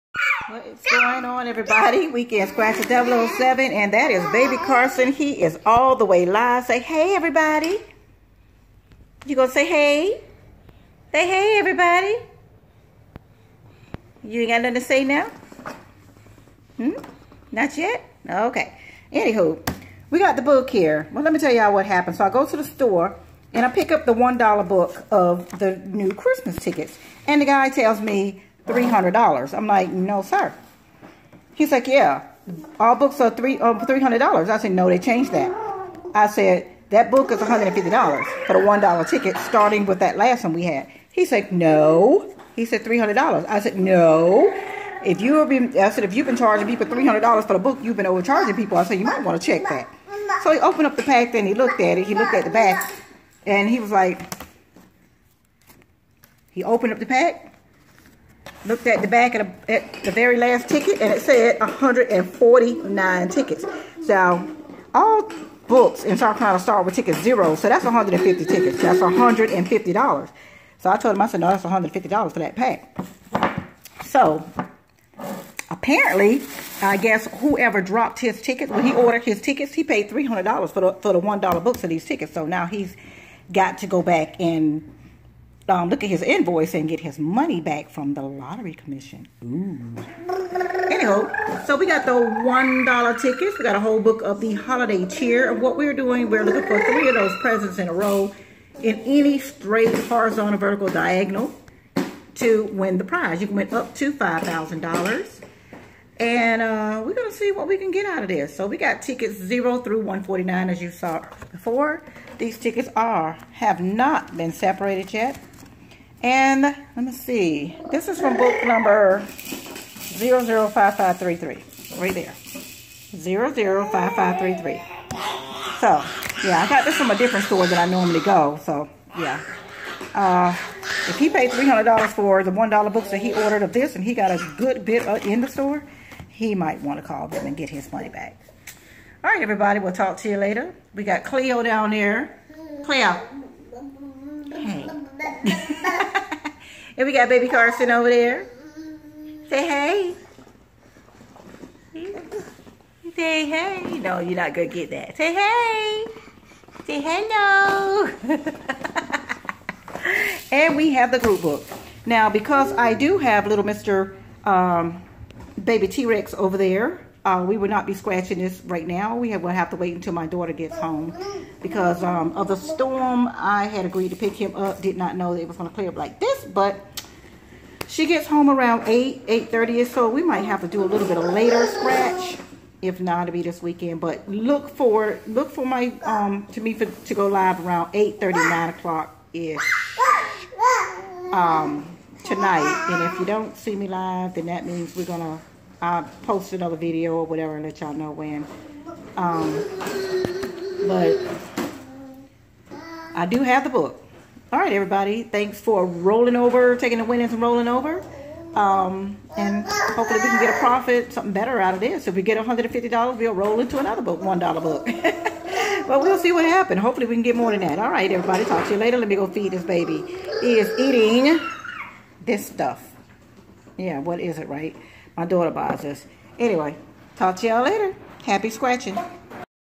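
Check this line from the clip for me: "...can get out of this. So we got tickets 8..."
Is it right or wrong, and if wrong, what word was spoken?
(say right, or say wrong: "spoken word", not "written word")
wrong: "0", not "8".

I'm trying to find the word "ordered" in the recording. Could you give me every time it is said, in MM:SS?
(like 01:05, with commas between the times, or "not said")
01:18, 02:13.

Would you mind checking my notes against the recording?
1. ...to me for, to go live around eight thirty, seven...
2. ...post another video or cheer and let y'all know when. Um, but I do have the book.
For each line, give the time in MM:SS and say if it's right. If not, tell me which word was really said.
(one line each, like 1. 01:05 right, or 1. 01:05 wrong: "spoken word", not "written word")
1. 03:06 wrong: "nine", not "seven"
2. 03:16 wrong: "whatever", not "cheer".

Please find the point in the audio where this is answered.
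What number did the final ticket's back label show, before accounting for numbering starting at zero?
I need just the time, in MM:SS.
01:01.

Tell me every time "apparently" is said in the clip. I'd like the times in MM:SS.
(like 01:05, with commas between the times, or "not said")
01:15.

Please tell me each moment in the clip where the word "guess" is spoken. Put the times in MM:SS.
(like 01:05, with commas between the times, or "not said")
01:16.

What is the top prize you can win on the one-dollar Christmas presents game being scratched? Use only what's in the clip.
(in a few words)
$5,000.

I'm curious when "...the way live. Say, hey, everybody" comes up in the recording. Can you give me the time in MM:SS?
00:05.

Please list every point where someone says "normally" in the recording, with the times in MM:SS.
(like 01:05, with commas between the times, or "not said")
02:07.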